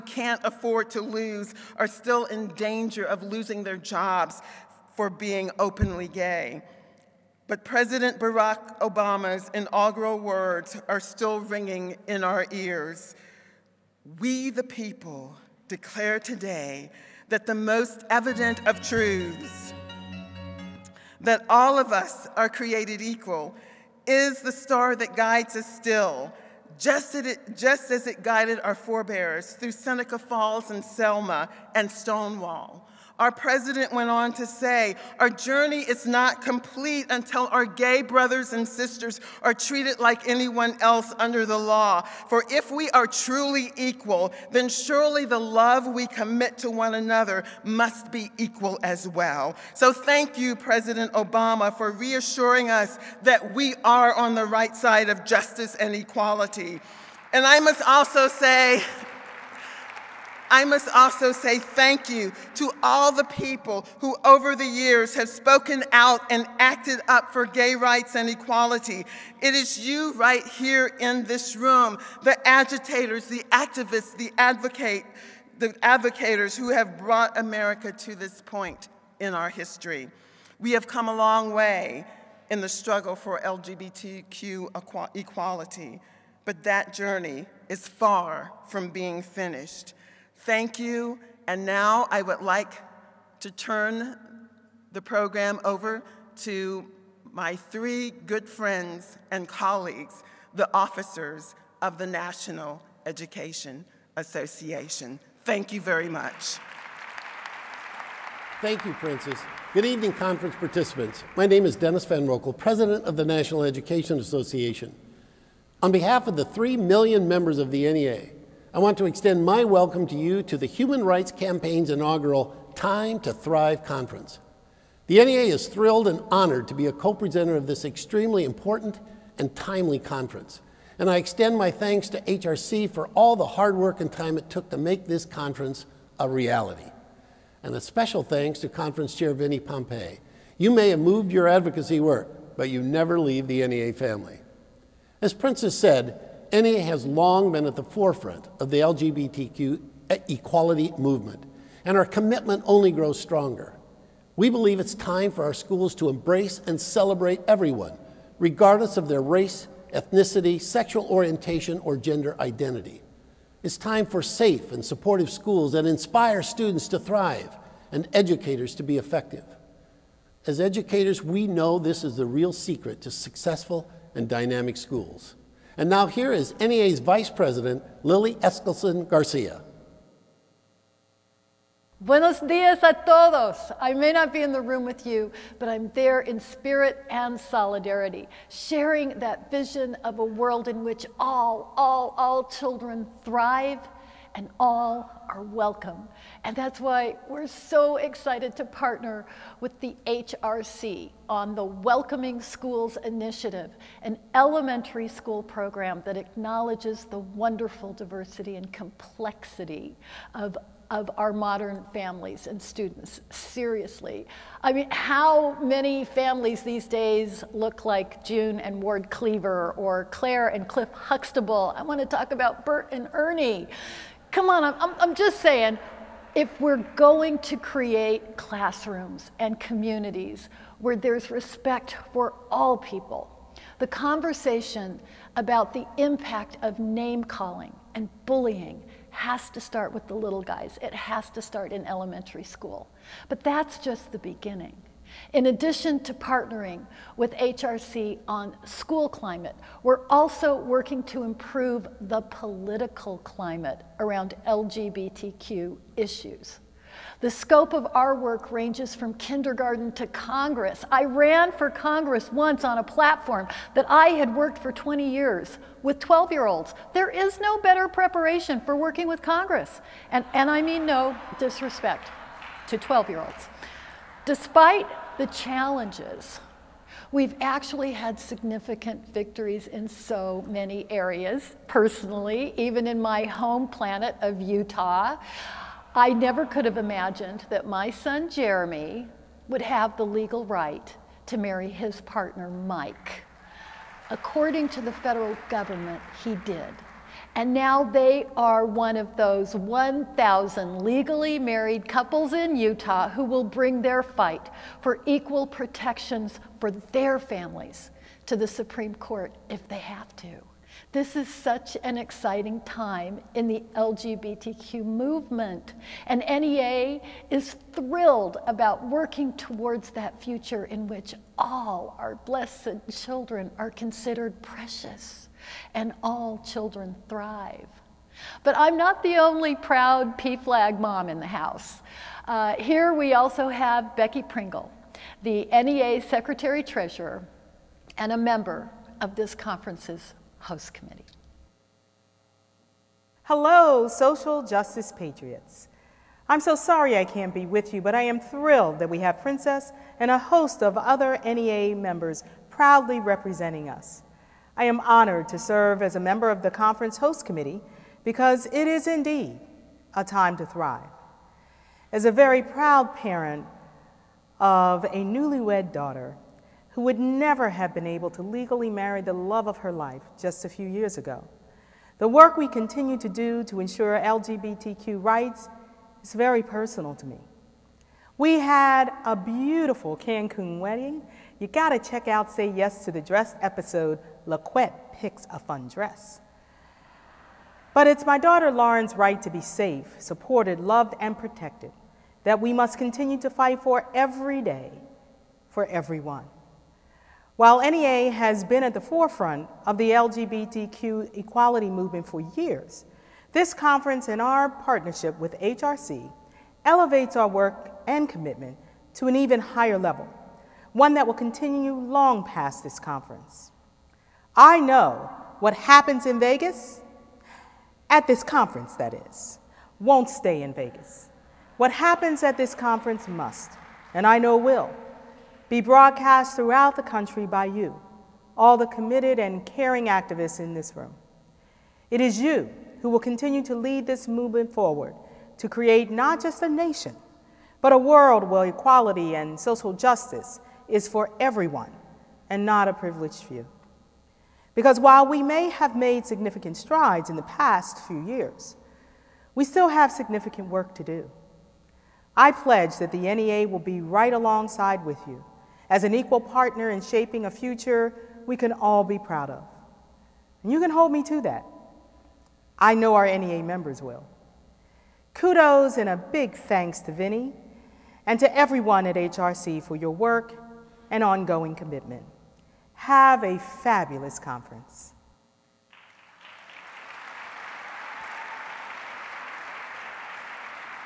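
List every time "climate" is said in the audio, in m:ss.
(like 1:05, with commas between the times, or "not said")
4:09, 4:13.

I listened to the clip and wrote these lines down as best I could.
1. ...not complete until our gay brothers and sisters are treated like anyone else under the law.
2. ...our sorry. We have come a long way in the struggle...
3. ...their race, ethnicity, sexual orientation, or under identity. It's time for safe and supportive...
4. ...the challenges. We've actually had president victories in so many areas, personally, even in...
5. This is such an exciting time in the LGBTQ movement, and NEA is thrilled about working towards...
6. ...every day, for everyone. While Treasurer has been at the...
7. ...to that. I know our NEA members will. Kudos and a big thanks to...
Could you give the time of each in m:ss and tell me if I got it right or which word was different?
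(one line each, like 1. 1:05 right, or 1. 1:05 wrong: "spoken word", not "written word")
1. 0:36 right
2. 1:19 wrong: "history", not "sorry"
3. 2:39 wrong: "gender", not "under"
4. 4:35 wrong: "significant", not "president"
5. 5:10 right
6. 6:33 wrong: "NEA", not "Treasurer"
7. 7:41 right.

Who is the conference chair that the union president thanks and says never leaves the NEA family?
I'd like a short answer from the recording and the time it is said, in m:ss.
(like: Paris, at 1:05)
Vinnie Pompei, at 2:19.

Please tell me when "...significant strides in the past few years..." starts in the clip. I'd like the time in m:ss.
7:26.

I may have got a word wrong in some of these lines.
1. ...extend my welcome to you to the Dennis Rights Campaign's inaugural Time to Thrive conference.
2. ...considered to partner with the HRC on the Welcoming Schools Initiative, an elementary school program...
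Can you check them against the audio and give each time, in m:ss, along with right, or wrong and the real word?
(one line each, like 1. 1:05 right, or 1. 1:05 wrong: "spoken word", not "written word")
1. 1:59 wrong: "Human", not "Dennis"
2. 3:17 wrong: "excited", not "considered".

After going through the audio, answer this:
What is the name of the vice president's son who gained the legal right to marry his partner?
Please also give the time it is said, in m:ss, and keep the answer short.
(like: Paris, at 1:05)
Jeremy, at 4:48.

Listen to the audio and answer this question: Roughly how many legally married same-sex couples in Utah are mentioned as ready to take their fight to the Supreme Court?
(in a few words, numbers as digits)
1,000.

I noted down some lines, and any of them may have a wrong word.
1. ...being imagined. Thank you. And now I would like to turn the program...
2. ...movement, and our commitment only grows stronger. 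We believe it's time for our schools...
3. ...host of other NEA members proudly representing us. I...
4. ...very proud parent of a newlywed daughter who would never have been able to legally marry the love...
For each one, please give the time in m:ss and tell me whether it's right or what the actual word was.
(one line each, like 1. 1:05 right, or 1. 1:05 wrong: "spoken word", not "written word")
1. 1:28 wrong: "finished", not "imagined"
2. 2:30 right
3. 5:50 right
4. 6:02 right.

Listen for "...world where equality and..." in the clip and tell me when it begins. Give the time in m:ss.
7:17.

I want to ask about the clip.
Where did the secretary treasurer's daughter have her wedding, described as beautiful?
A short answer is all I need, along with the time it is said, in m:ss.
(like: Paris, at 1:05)
Cancun, at 6:19.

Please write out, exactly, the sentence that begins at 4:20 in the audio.
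I ran for Congress once on a platform that I had worked for 20 years with 12 year olds.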